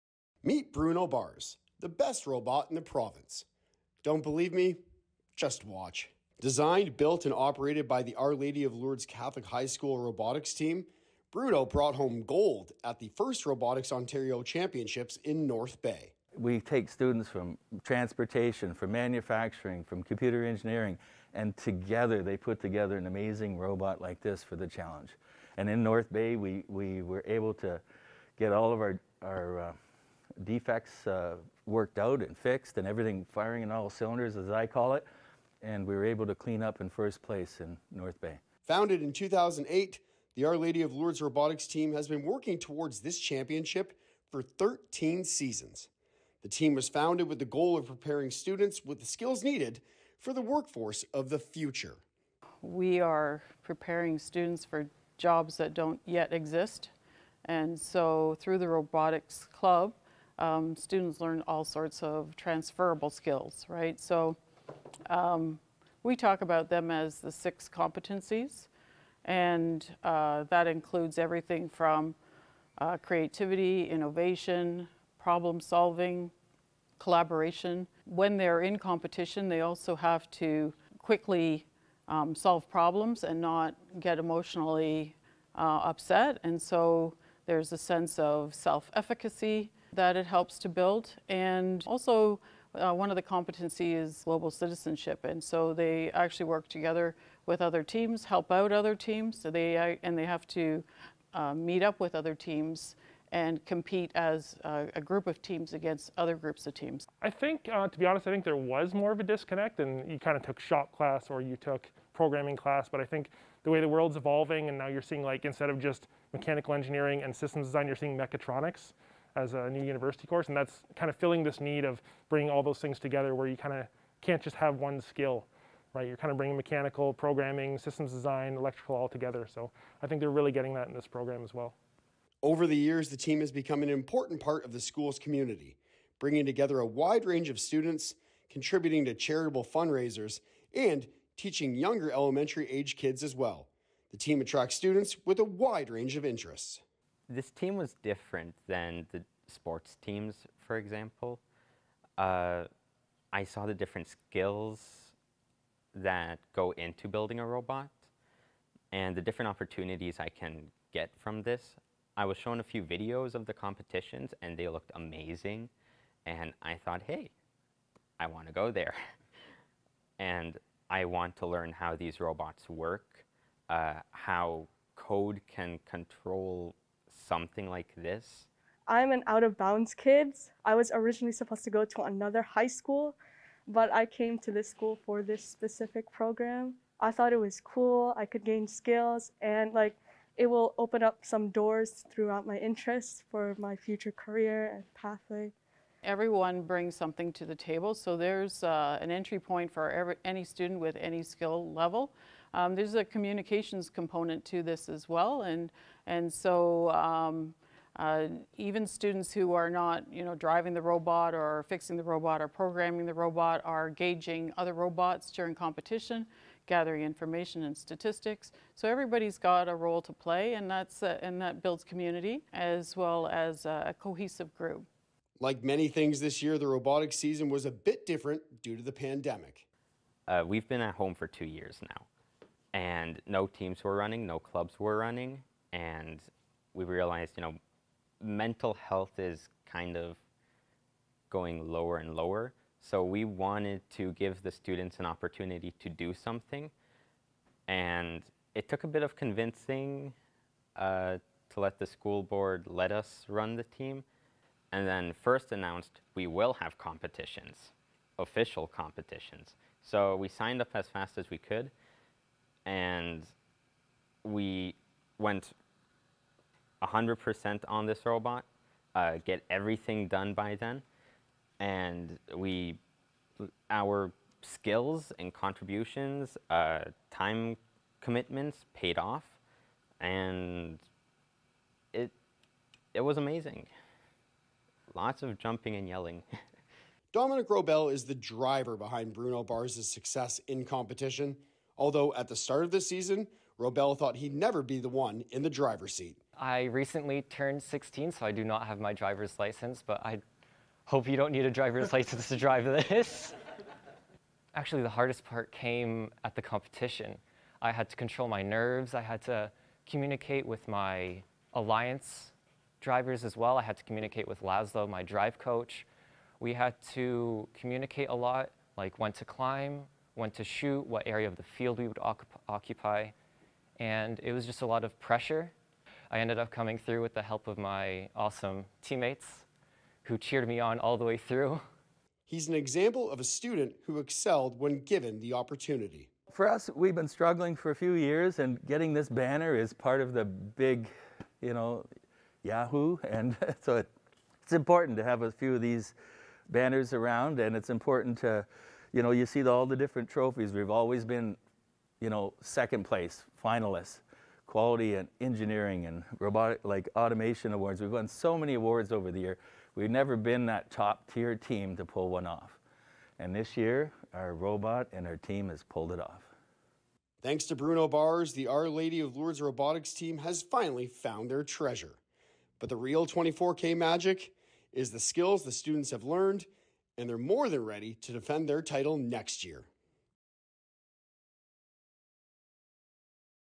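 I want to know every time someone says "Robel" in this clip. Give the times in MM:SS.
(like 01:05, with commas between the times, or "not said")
04:47, 04:53.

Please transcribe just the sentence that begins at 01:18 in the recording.
When they're in competition, they also have to quickly um, solve problems and not get emotionally uh, upset.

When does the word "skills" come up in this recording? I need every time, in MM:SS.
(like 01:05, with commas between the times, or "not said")
00:49, 01:03, 02:05, 02:34, 03:08, 03:21, 04:34, 06:14.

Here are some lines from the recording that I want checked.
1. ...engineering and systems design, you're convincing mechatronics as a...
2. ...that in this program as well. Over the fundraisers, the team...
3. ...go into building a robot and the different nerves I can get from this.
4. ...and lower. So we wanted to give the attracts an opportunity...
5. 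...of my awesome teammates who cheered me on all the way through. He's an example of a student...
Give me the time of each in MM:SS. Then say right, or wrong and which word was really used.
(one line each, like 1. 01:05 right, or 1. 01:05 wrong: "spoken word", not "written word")
1. 01:56 wrong: "seeing", not "convincing"
2. 02:10 wrong: "years", not "fundraisers"
3. 02:36 wrong: "opportunities", not "nerves"
4. 04:01 wrong: "students", not "attracts"
5. 05:27 right.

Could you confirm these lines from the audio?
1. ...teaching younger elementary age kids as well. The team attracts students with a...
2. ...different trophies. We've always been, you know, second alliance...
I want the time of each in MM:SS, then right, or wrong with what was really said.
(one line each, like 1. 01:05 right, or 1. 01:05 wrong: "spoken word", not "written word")
1. 02:21 right
2. 05:49 wrong: "place", not "alliance".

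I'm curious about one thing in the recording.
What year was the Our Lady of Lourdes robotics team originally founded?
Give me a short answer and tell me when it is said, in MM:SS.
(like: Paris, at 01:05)
2008, at 00:39.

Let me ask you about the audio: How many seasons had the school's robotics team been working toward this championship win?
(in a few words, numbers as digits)
13.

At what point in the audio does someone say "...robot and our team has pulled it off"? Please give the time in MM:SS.
06:04.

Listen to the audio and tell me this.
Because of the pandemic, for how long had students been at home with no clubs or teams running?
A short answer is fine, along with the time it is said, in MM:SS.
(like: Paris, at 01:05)
2 years, at 03:51.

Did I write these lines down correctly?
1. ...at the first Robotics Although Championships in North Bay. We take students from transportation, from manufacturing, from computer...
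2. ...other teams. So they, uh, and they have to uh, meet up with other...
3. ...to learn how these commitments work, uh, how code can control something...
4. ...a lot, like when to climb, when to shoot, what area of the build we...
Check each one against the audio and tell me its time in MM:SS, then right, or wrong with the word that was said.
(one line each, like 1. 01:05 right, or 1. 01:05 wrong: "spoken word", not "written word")
1. 00:12 wrong: "Ontario", not "Although"
2. 01:38 right
3. 02:51 wrong: "robots", not "commitments"
4. 05:18 wrong: "field", not "build".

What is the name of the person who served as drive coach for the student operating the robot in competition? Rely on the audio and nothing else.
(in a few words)
Laszlo.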